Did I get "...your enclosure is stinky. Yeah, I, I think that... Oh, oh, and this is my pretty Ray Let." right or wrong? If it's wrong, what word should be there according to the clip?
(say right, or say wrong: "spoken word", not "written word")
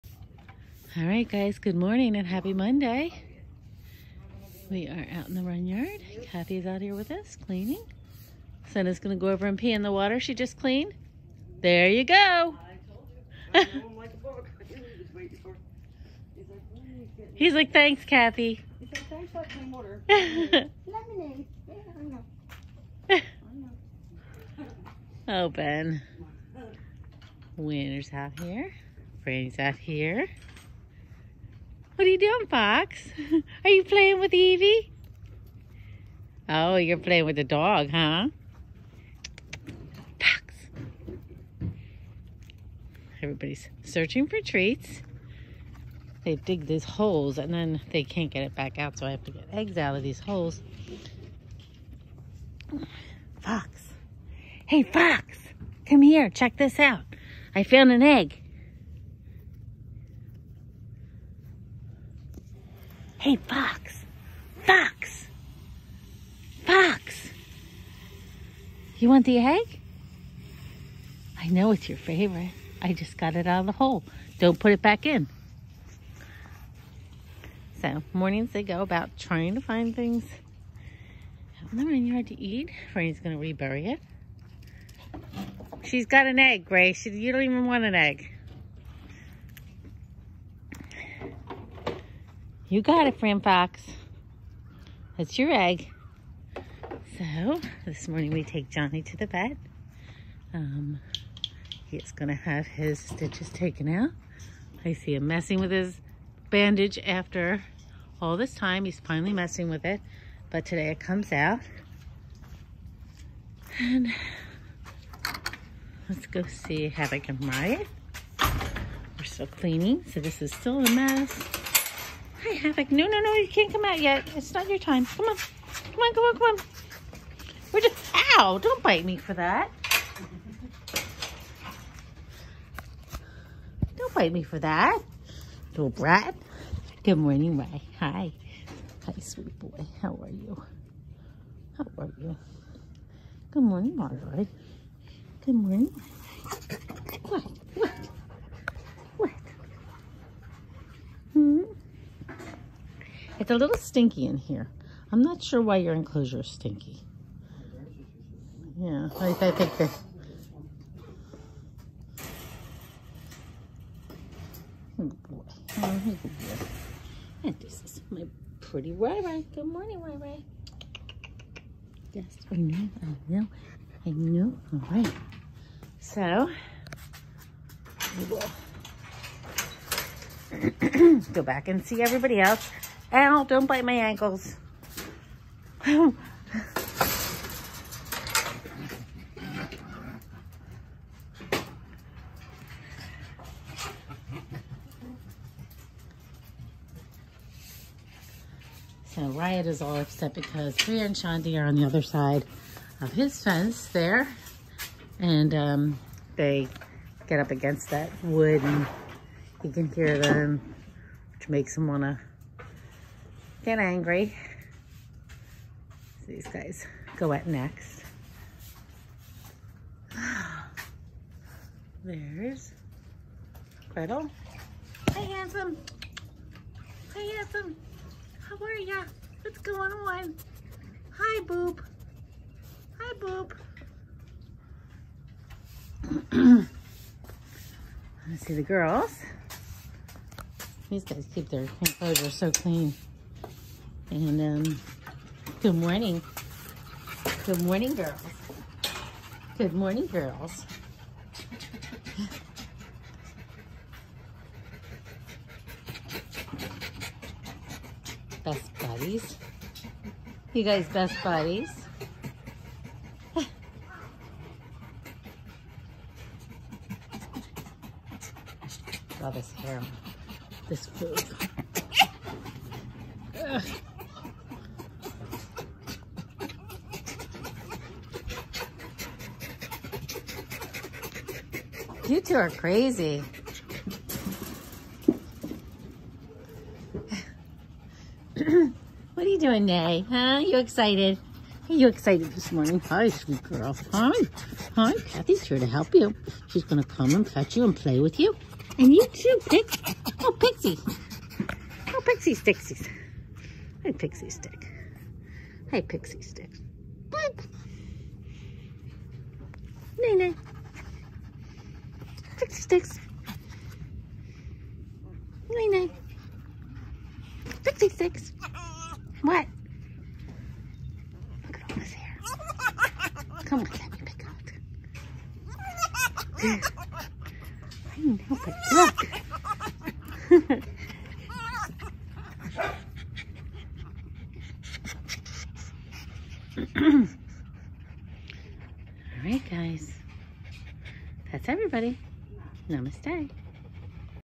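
wrong: "Ray", not "Let".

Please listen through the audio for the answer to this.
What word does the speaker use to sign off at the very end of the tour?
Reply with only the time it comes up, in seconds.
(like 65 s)
342 s.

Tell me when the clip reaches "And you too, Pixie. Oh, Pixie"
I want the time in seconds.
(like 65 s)
298 s.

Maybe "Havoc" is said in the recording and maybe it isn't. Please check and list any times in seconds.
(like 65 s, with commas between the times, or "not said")
116 s, 122 s.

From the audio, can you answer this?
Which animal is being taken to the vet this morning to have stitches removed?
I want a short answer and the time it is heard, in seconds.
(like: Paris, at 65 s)
Johnny, at 98 s.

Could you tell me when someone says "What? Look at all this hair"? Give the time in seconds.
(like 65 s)
319 s.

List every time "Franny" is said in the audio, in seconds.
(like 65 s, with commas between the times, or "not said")
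29 s, 82 s.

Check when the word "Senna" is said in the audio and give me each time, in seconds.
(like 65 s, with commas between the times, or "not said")
8 s.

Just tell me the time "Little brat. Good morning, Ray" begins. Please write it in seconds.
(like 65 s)
135 s.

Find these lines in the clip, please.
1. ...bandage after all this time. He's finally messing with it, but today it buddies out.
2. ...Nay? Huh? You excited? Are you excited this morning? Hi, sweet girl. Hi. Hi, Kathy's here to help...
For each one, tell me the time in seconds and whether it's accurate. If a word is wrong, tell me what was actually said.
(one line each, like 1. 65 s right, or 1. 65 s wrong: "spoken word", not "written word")
1. 106 s wrong: "comes", not "buddies"
2. 289 s right.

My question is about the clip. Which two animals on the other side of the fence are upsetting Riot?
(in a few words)
Priya and Shanti.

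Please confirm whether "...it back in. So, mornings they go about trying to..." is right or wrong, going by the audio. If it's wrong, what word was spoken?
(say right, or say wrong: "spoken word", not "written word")
right.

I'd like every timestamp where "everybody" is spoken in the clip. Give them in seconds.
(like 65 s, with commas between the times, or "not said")
43 s, 182 s, 341 s.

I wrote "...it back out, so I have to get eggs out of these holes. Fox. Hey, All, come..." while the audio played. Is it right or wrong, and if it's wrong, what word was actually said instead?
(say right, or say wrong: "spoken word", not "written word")
wrong: "Fox", not "All".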